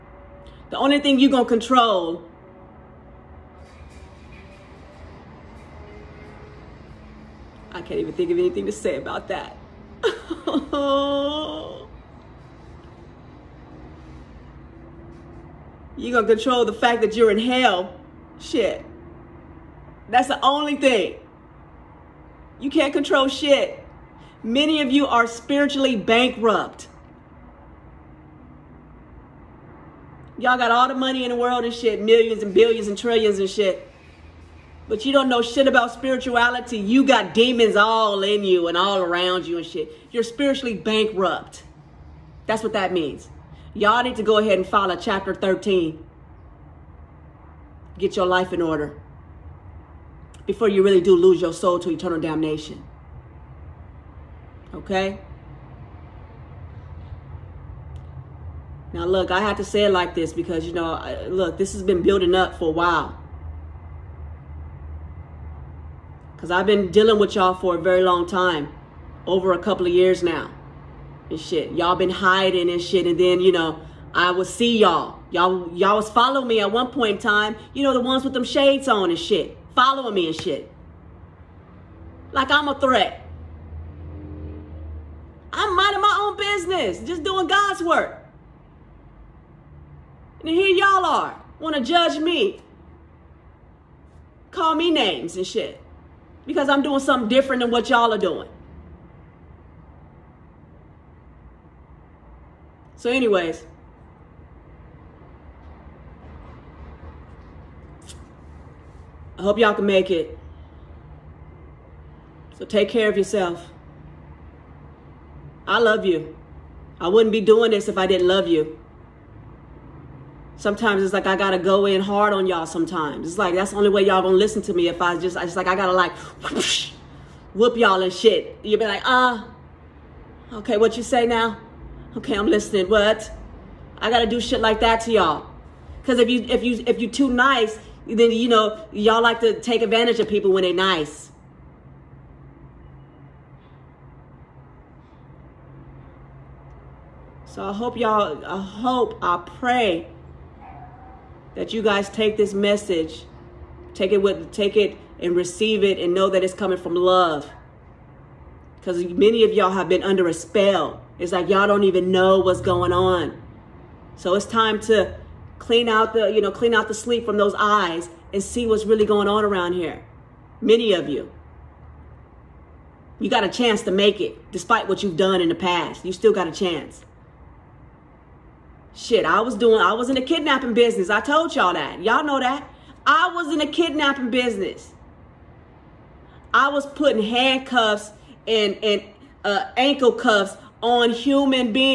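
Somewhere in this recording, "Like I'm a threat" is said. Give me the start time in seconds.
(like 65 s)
82 s.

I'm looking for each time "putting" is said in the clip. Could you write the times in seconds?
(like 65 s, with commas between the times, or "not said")
186 s.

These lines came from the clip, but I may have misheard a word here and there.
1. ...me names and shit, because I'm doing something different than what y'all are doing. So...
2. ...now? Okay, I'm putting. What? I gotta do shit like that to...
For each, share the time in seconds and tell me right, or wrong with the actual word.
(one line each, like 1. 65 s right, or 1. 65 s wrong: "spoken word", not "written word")
1. 94 s right
2. 131 s wrong: "listening", not "putting".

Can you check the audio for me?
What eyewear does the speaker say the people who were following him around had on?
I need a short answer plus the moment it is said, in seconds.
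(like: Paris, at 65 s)
Shades, at 78 s.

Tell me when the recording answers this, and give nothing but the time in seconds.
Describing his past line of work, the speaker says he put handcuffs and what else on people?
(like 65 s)
189 s.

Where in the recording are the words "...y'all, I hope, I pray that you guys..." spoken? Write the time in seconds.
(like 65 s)
147 s.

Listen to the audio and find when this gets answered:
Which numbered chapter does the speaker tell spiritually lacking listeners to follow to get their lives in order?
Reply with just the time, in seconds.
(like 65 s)
44 s.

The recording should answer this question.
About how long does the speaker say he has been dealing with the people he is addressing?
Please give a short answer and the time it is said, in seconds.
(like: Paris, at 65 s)
A couple of years, at 69 s.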